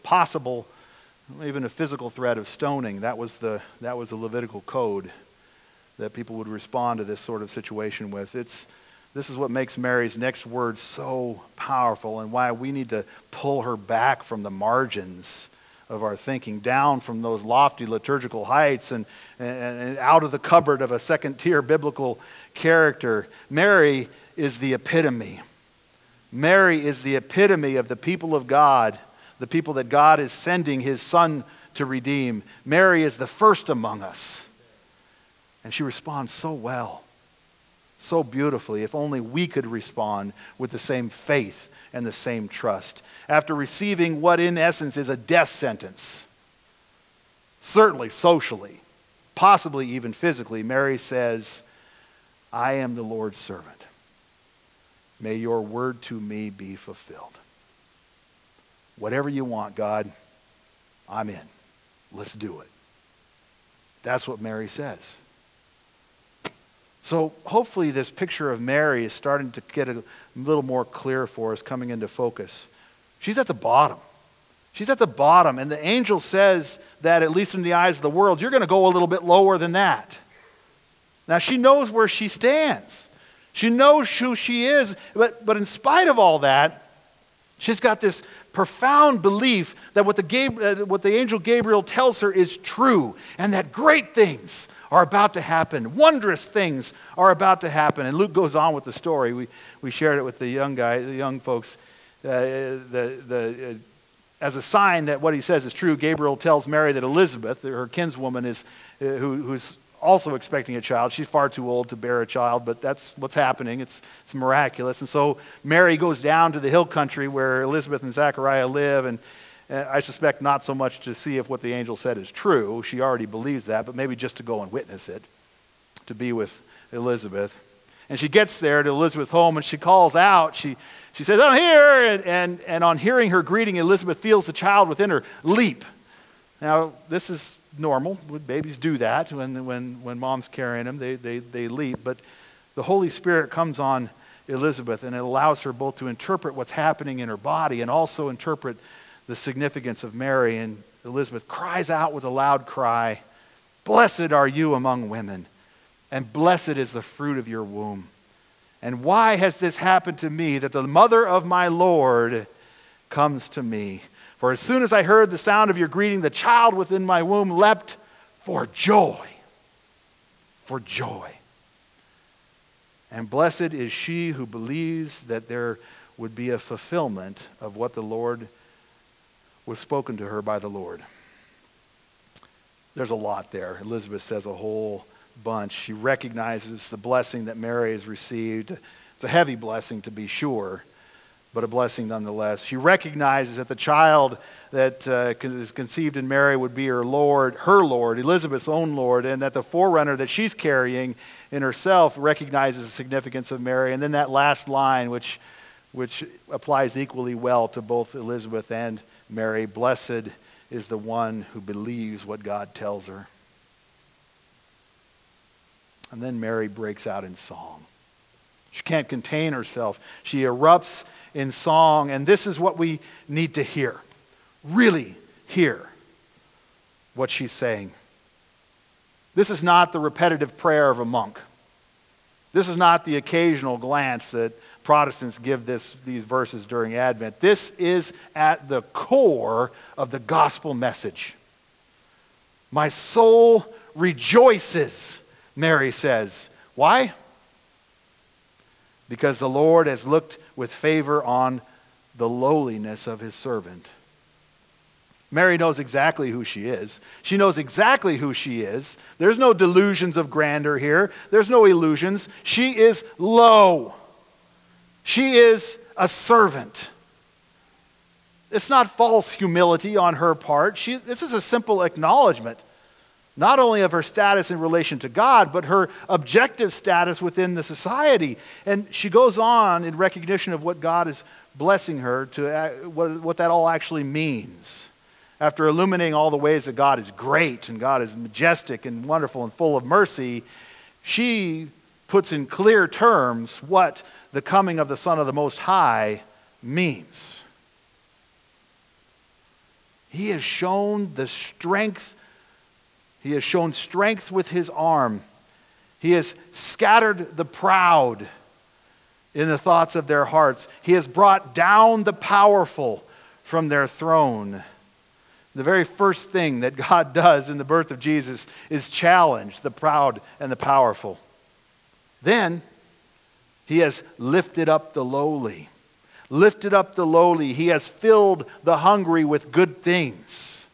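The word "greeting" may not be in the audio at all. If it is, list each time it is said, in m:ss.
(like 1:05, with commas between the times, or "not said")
2:13, 2:45.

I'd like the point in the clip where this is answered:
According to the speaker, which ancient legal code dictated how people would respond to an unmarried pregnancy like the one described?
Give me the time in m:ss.
0:04.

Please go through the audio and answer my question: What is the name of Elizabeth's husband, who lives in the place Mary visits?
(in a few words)
Zachariah.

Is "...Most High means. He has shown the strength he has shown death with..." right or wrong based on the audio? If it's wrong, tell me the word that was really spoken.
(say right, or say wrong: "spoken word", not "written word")
wrong: "strength", not "death".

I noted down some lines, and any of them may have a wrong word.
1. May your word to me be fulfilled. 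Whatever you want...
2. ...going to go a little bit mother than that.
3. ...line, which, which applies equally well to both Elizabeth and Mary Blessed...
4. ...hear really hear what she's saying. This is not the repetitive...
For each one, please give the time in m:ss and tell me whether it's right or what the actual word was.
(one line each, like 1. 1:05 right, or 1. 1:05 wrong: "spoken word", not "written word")
1. 0:55 right
2. 1:18 wrong: "lower", not "mother"
3. 3:24 right
4. 3:43 right.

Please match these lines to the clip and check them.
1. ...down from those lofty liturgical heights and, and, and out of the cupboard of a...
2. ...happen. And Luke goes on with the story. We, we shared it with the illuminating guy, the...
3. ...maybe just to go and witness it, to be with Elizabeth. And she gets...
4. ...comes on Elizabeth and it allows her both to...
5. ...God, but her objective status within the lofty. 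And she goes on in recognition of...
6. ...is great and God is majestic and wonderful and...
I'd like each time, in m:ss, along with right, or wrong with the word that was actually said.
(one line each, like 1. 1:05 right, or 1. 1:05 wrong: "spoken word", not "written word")
1. 0:16 right
2. 1:37 wrong: "young", not "illuminating"
3. 2:03 right
4. 2:23 right
5. 4:35 wrong: "society", not "lofty"
6. 4:46 right.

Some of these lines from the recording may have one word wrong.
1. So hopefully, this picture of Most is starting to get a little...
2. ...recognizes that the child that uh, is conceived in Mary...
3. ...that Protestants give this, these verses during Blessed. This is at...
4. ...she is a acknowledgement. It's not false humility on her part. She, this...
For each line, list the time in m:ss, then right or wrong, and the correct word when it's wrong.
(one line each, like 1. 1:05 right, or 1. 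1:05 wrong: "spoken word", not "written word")
1. 1:07 wrong: "Mary", not "Most"
2. 3:12 right
3. 3:54 wrong: "Advent", not "Blessed"
4. 4:25 wrong: "servant", not "acknowledgement".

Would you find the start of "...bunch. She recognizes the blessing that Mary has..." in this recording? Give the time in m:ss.
3:05.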